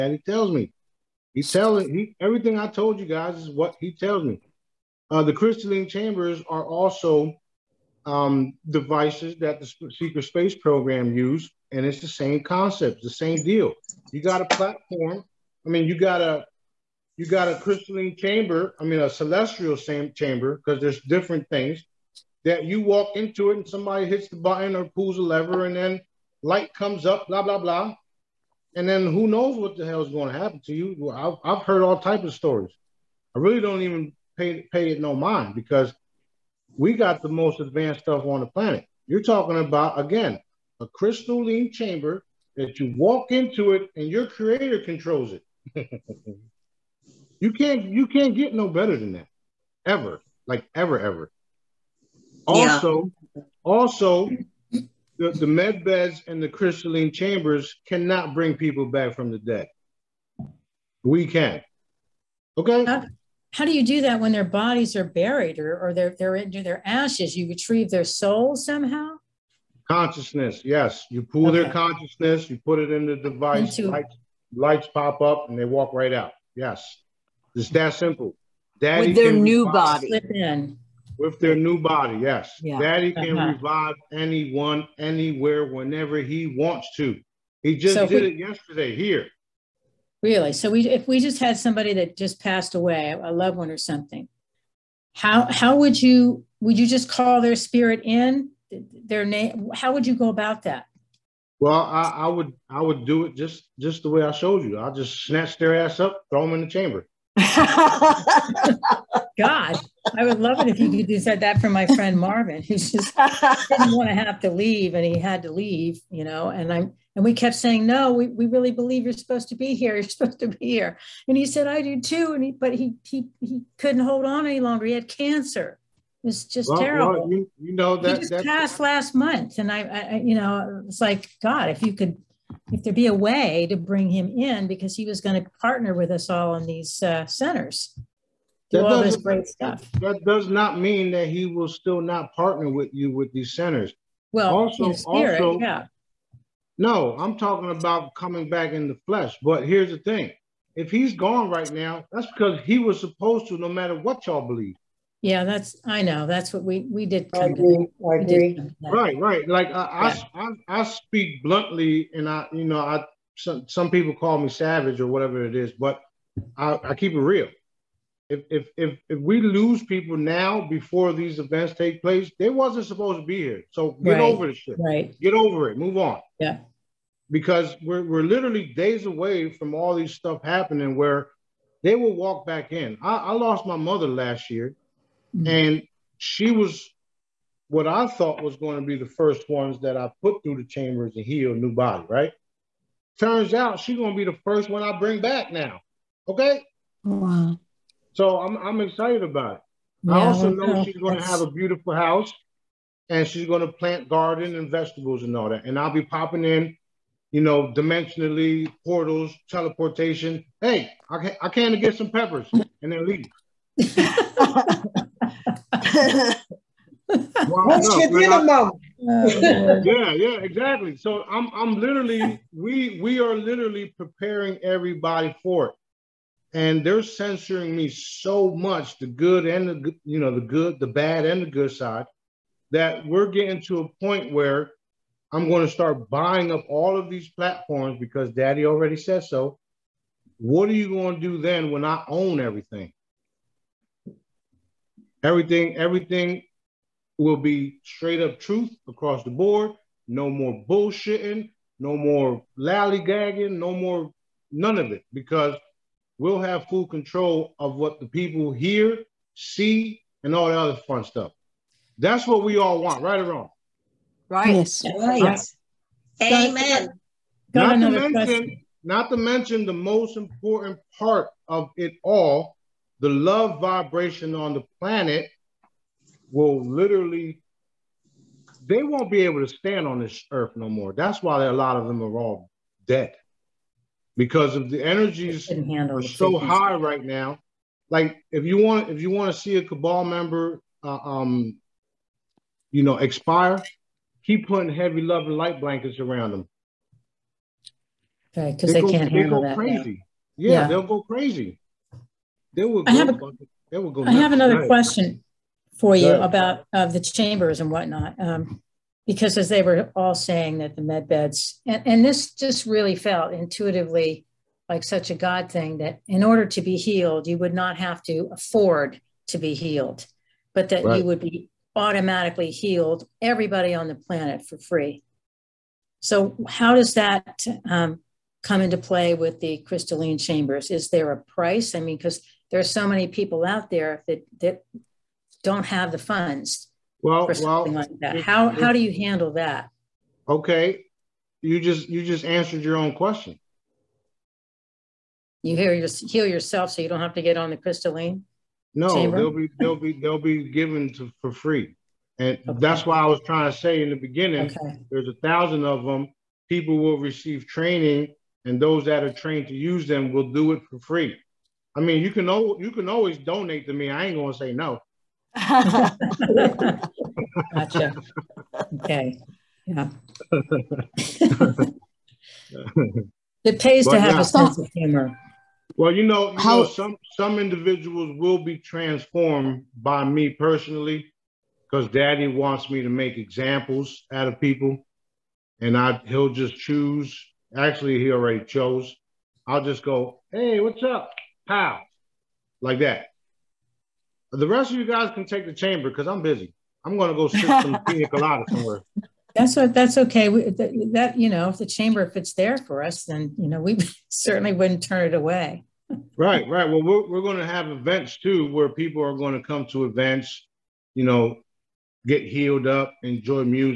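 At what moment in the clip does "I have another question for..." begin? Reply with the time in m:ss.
5:04.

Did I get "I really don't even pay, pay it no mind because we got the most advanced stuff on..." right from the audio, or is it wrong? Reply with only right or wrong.
right.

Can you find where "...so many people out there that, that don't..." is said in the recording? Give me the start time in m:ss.
5:32.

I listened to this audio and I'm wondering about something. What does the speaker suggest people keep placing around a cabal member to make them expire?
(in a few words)
love and light blankets.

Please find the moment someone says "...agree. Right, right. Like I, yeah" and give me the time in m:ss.
2:38.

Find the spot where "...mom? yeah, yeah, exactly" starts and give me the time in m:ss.
3:38.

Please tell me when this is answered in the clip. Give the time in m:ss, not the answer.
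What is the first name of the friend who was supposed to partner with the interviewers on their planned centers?
1:52.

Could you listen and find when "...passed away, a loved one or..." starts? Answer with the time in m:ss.
1:32.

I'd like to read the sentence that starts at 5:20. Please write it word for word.
you would be automatically healed, everybody on the planet for free.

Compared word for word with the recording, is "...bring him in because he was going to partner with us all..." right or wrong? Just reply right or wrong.
right.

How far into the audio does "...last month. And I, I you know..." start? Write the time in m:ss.
2:08.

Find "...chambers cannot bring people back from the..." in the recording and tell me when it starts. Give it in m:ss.
0:57.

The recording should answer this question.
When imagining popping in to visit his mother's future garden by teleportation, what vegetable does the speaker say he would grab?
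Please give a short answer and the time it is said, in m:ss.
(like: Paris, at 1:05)
peppers, at 3:32.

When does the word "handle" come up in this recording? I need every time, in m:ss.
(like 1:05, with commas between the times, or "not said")
4:59, 5:39.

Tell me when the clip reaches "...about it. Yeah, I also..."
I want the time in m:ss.
3:19.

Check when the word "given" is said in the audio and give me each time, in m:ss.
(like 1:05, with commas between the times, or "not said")
5:50.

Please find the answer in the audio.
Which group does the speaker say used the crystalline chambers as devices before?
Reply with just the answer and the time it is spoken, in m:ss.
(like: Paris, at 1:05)
the secret space program, at 0:09.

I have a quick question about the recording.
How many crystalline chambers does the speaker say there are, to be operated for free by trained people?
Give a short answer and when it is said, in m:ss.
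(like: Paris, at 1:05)
1000, at 5:55.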